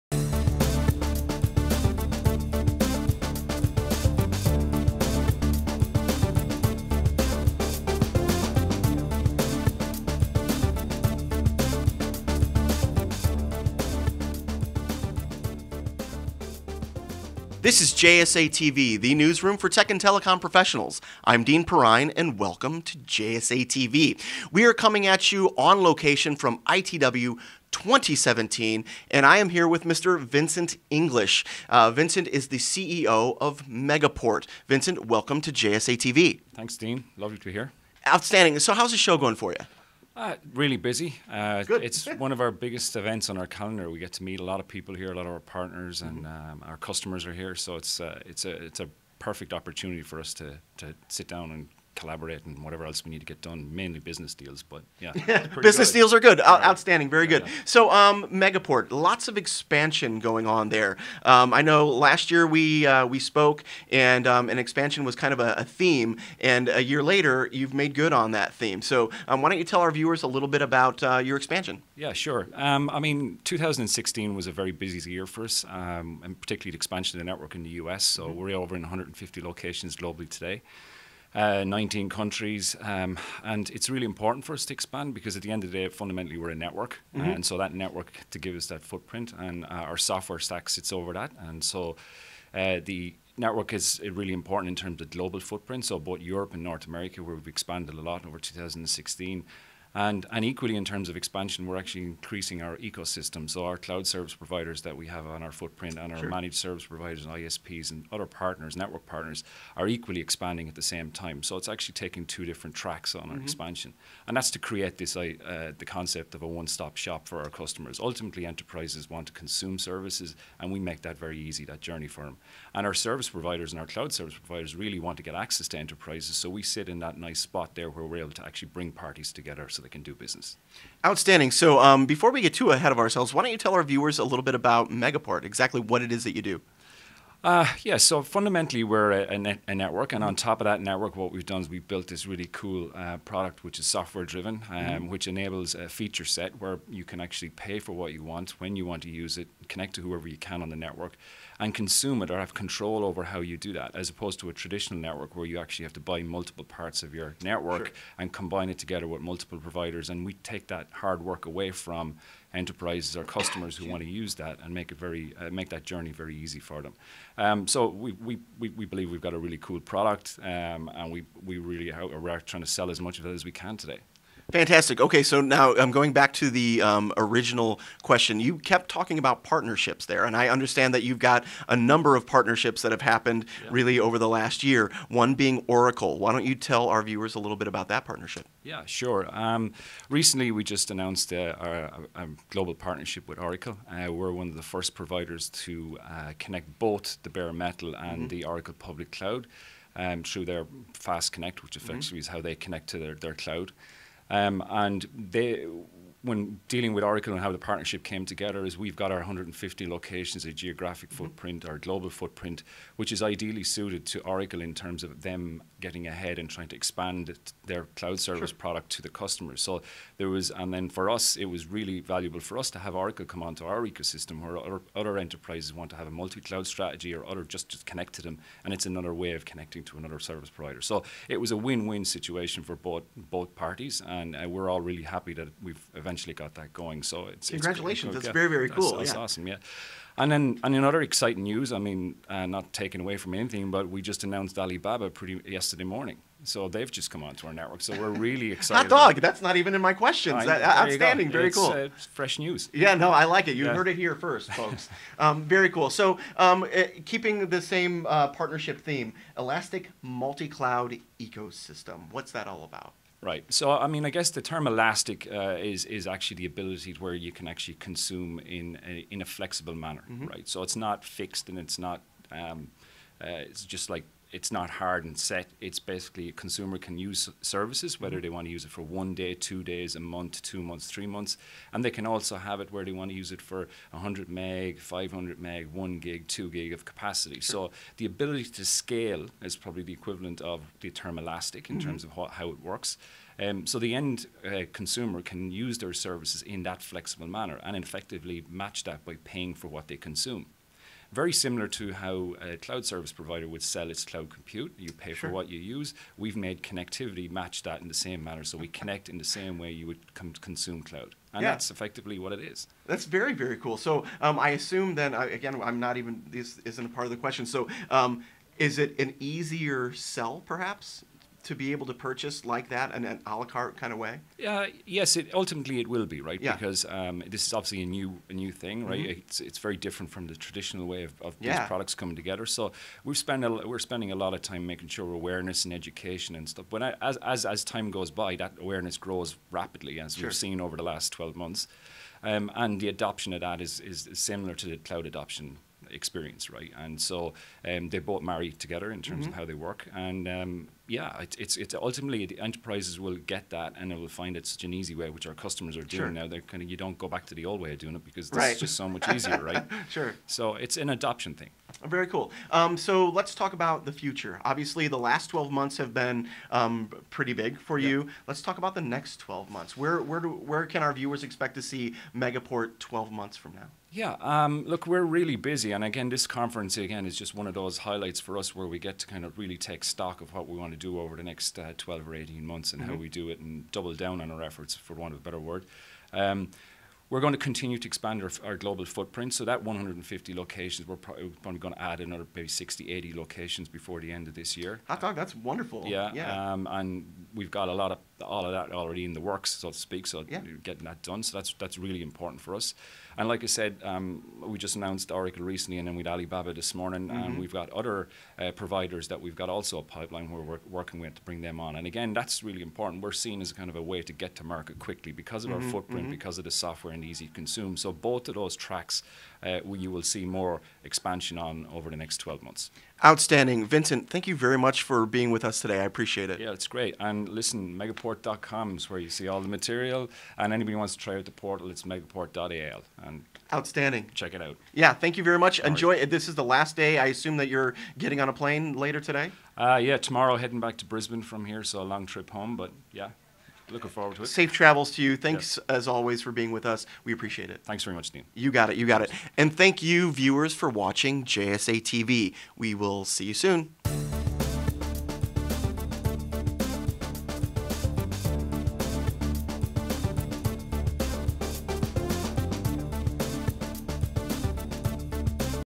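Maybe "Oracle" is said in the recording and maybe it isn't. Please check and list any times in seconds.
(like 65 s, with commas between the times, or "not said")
185 s, 193 s, 198 s, 207 s, 214 s, 222 s, 405 s.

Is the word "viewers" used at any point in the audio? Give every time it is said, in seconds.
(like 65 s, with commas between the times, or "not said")
69 s, 133 s, 187 s, 370 s, 450 s.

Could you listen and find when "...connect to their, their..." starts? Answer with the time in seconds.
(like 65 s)
202 s.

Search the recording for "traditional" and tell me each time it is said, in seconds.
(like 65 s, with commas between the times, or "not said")
154 s, 330 s.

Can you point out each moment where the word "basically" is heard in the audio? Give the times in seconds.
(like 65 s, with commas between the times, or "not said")
275 s.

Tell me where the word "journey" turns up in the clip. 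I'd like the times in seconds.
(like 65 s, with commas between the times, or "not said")
121 s, 165 s.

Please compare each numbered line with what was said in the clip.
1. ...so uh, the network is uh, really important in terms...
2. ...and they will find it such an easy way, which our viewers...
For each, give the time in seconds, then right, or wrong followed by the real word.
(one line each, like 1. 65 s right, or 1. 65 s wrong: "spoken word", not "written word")
1. 91 s right
2. 353 s wrong: "customers", not "viewers".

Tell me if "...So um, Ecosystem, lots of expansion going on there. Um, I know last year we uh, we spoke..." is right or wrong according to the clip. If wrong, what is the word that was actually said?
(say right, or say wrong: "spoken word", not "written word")
wrong: "Megaport", not "Ecosystem".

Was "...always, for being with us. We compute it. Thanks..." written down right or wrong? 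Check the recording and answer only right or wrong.
wrong.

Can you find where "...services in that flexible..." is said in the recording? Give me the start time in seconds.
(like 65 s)
295 s.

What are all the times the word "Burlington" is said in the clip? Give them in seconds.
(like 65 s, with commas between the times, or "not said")
not said.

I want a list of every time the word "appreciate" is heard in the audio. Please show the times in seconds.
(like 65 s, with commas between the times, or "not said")
425 s, 447 s.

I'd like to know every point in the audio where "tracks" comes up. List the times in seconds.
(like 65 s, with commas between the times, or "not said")
112 s, 418 s.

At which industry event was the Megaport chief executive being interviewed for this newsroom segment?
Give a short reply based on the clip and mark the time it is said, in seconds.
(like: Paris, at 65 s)
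ITW 2017, at 26 s.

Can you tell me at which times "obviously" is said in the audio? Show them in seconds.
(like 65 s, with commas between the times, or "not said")
327 s, 364 s.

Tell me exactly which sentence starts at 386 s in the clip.
Um, we're going to continue to expand our, our, global footprint.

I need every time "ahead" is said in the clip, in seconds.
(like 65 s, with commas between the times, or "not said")
132 s, 216 s.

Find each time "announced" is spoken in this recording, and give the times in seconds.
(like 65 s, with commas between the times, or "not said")
190 s, 244 s, 404 s.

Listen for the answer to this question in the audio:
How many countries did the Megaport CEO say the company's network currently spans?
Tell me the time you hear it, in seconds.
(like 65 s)
81 s.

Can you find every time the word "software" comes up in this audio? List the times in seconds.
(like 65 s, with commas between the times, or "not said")
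89 s, 143 s, 416 s.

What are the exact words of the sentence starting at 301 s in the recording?
Very similar to how a cloud service provider would sell its cloud compute.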